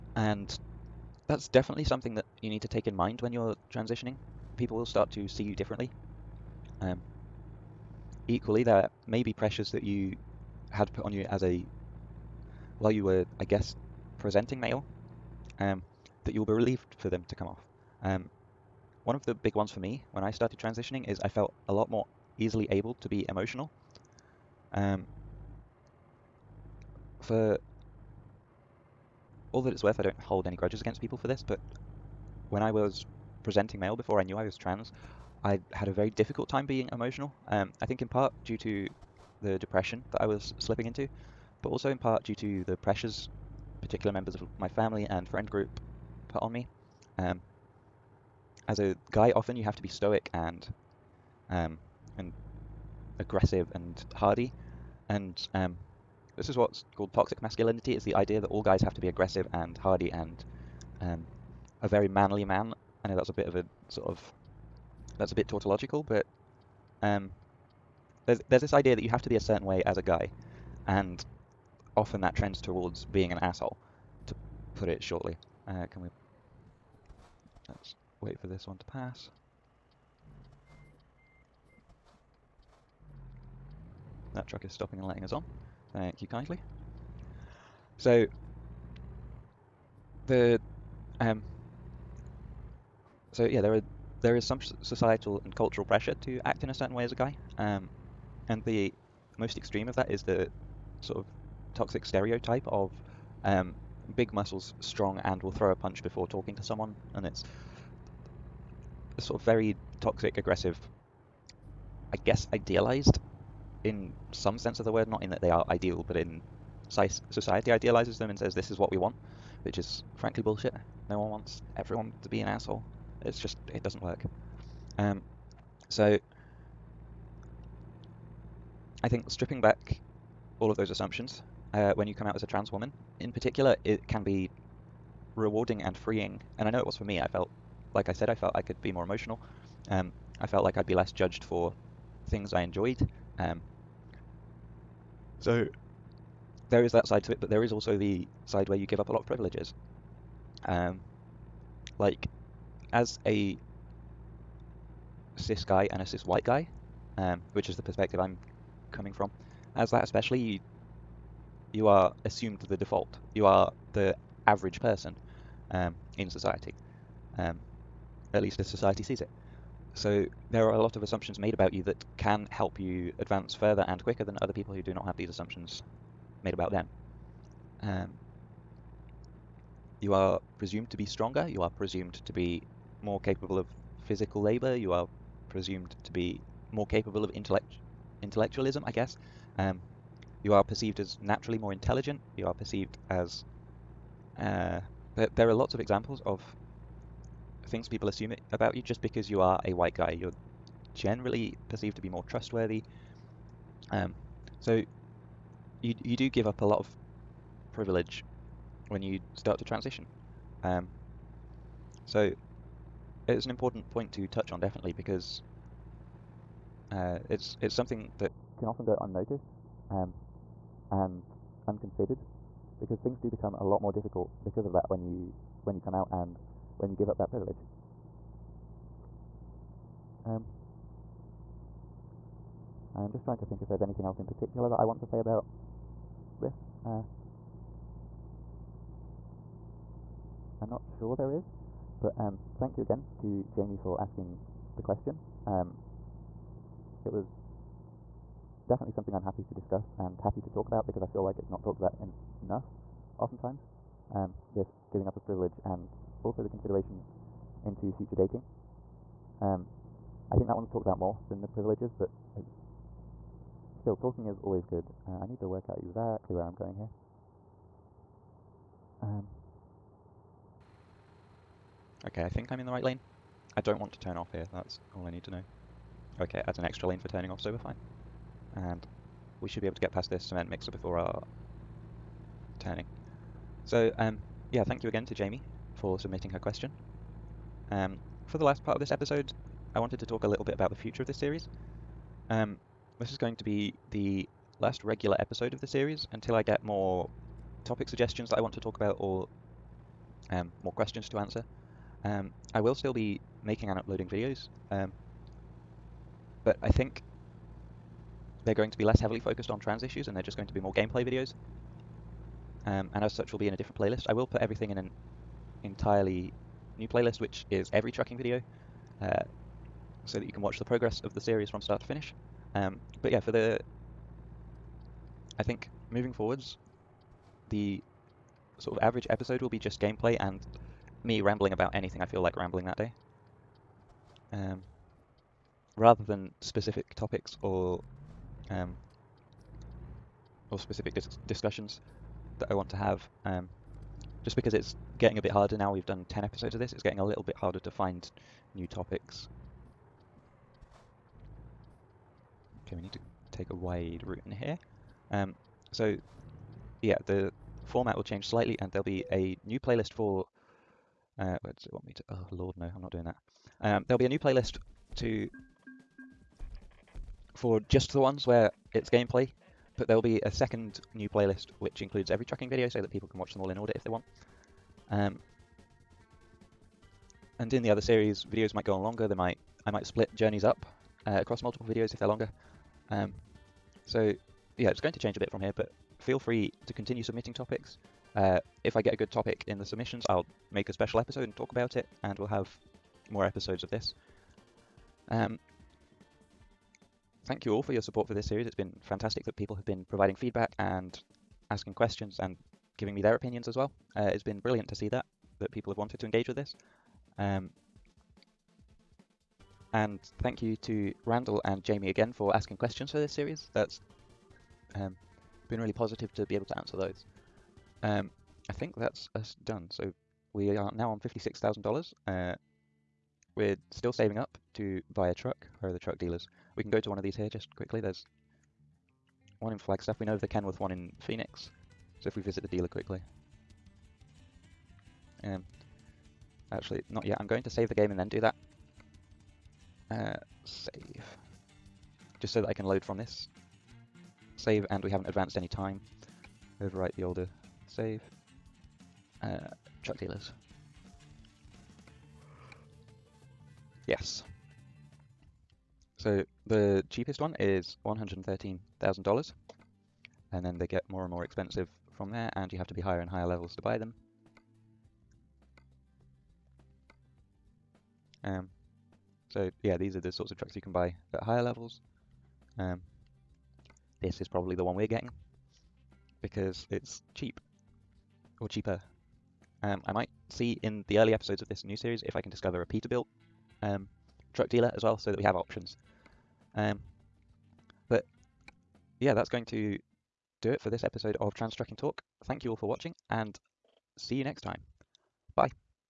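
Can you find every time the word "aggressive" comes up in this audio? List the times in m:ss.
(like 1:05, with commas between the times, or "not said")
0:53, 0:59, 1:50.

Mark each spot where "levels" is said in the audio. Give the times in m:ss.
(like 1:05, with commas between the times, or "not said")
7:43, 7:51.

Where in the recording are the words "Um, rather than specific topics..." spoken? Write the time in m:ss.
5:34.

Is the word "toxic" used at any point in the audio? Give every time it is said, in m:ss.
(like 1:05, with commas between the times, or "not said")
0:57, 1:41, 1:50.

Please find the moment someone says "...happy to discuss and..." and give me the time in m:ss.
4:09.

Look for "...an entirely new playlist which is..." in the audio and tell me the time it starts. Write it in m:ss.
5:14.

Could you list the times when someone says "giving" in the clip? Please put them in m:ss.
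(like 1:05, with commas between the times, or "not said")
4:14, 6:42.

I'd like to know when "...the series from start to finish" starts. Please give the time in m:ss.
5:21.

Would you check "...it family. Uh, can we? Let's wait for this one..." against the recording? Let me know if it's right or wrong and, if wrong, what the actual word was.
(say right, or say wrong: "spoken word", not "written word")
wrong: "shortly", not "family".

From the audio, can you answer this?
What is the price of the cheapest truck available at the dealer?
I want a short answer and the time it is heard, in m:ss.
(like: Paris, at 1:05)
$113,000, at 7:37.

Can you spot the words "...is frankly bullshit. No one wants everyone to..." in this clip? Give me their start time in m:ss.
1:59.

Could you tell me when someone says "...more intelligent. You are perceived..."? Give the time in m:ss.
3:11.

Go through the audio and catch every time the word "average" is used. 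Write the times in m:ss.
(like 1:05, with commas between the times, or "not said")
2:44, 5:28.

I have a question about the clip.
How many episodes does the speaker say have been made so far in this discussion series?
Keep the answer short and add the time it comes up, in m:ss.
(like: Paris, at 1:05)
10, at 5:46.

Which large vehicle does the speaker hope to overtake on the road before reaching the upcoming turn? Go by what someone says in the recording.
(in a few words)
cement mixer.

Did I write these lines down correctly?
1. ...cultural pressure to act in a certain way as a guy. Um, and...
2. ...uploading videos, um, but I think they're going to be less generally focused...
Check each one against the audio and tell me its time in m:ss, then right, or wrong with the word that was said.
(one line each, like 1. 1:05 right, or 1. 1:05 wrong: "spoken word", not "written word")
1. 1:35 right
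2. 5:03 wrong: "heavily", not "generally".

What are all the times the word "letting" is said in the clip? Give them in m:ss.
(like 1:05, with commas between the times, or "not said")
1:25.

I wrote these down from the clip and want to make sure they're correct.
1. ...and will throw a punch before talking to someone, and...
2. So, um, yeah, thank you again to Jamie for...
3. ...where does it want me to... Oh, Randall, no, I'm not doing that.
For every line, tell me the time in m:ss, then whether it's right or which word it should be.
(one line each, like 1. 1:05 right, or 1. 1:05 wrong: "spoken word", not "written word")
1. 1:45 right
2. 4:43 right
3. 6:01 wrong: "Lord", not "Randall".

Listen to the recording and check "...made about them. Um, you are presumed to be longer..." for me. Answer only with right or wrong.
wrong.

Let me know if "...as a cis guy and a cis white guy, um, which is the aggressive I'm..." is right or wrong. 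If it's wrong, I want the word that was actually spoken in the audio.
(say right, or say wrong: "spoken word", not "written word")
wrong: "perspective", not "aggressive".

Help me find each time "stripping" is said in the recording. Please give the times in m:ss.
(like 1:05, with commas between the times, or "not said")
2:09.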